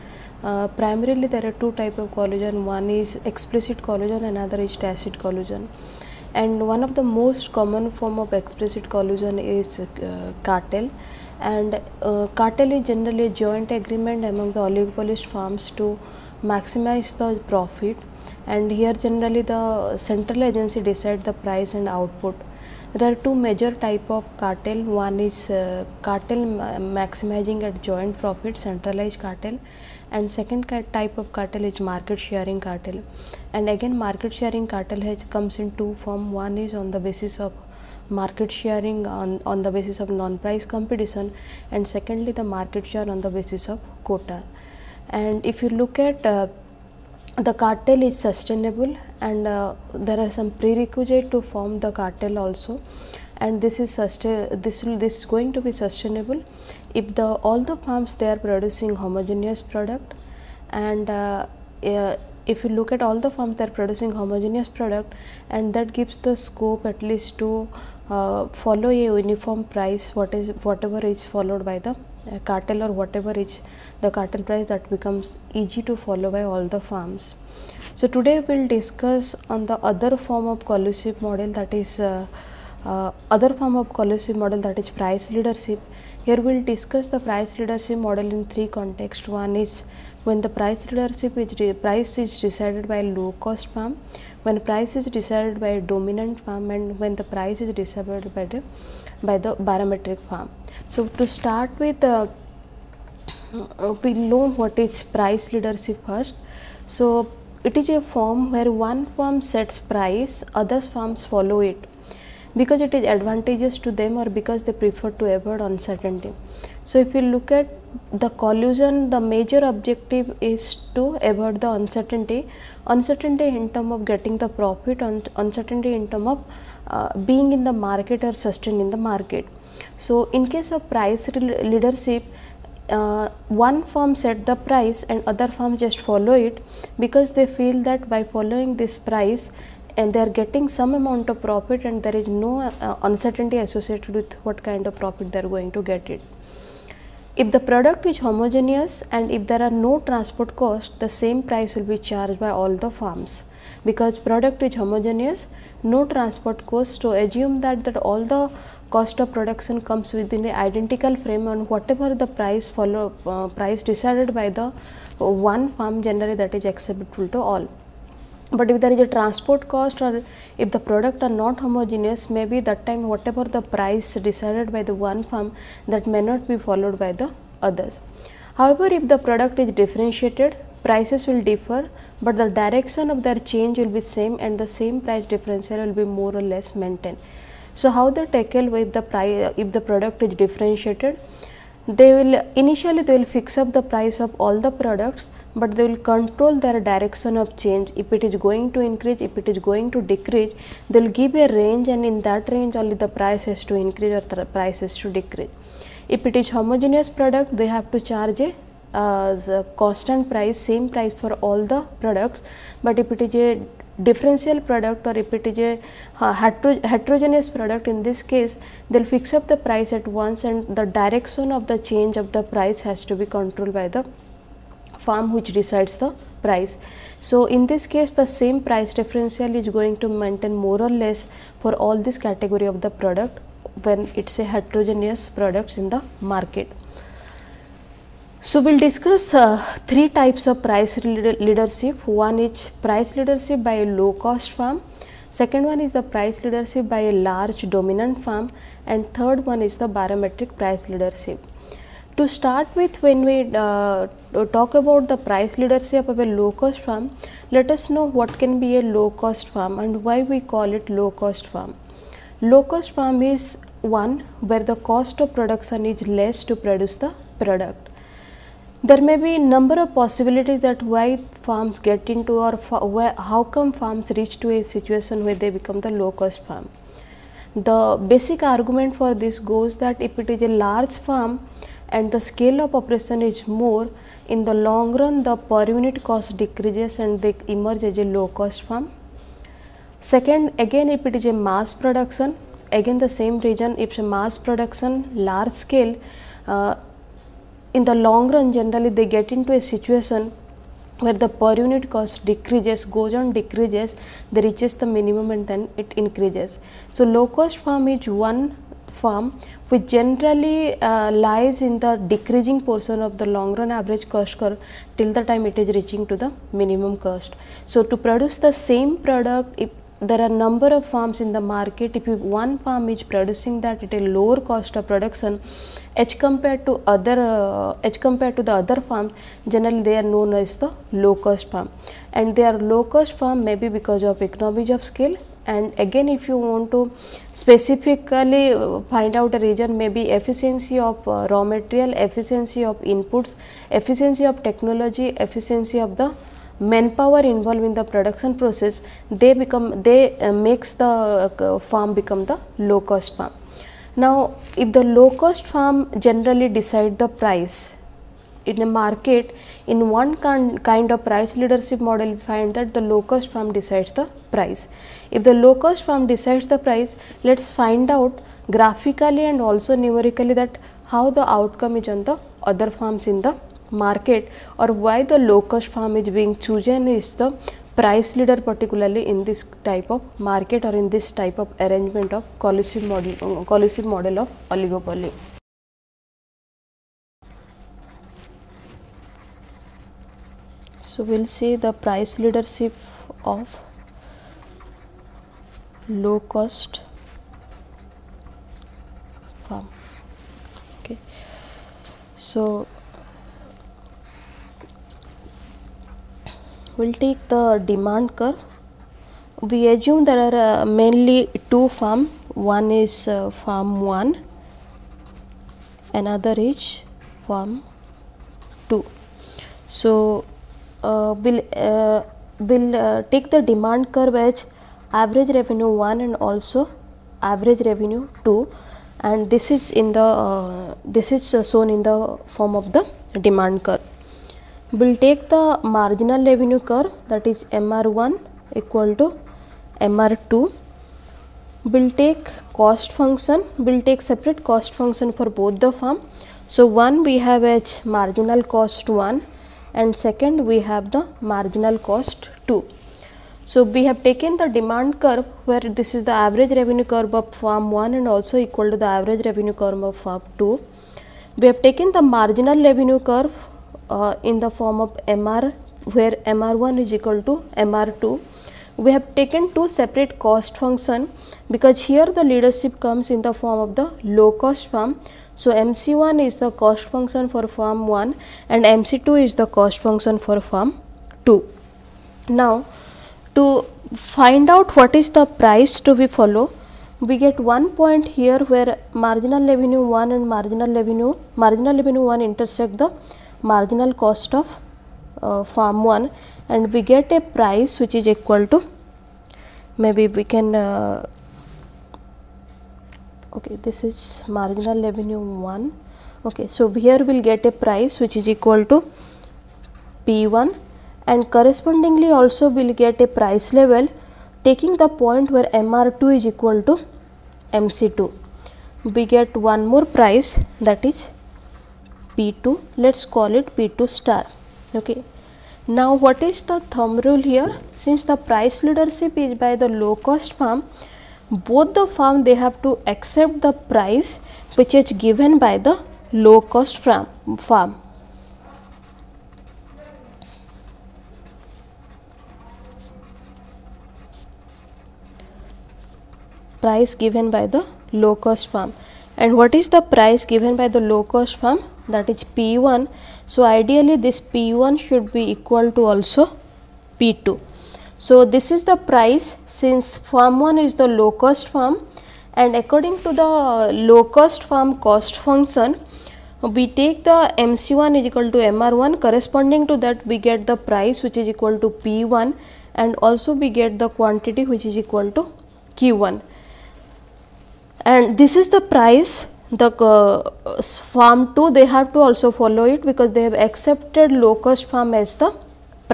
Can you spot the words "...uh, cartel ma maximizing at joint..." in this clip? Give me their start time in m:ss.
0:25.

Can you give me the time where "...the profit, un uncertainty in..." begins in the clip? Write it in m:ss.
2:04.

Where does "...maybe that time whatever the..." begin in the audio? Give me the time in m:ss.
2:52.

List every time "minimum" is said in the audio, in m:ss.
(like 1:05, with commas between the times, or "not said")
5:04, 5:16.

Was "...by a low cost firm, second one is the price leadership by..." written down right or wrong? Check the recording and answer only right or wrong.
right.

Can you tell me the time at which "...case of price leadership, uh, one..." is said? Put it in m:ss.
2:10.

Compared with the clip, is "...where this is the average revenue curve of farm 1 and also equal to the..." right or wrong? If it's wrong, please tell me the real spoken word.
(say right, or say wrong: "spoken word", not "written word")
right.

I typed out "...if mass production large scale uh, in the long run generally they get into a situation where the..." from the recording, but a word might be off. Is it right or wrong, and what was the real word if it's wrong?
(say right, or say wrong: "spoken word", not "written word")
right.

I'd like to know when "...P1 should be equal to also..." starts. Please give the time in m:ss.
9:14.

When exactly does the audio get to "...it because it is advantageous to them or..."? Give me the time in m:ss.
1:51.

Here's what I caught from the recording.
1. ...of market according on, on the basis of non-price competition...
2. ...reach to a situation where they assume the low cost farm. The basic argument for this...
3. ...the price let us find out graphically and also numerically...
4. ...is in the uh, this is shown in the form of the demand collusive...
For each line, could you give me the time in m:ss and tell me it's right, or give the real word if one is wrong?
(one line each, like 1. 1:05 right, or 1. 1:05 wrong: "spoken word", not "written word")
1. 0:37 wrong: "sharing", not "according"
2. 4:34 wrong: "become", not "assume"
3. 6:06 right
4. 7:09 wrong: "curve", not "collusive".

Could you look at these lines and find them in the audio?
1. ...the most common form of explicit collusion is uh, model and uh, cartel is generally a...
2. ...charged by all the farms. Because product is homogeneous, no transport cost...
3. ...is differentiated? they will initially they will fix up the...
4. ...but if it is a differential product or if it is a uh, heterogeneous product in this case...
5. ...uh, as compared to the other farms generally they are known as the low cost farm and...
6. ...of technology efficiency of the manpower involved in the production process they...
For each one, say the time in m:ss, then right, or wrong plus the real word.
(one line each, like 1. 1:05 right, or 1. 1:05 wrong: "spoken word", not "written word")
1. 0:06 wrong: "cartel", not "model"
2. 2:31 right
3. 3:10 right
4. 3:32 right
5. 5:27 right
6. 5:44 right.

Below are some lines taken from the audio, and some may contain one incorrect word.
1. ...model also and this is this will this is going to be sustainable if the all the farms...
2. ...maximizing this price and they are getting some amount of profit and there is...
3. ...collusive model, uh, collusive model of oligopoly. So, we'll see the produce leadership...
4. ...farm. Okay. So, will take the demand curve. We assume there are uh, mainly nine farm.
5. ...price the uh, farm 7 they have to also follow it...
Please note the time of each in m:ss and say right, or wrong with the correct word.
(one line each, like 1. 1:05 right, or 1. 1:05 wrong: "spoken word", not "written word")
1. 0:51 wrong: "cartel", not "model"
2. 2:18 wrong: "following", not "maximizing"
3. 6:22 wrong: "price", not "produce"
4. 6:39 wrong: "two", not "nine"
5. 9:38 wrong: "2", not "7".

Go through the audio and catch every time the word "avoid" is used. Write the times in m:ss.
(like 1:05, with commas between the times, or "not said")
1:55, 2:01.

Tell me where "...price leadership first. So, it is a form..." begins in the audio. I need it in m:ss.
1:45.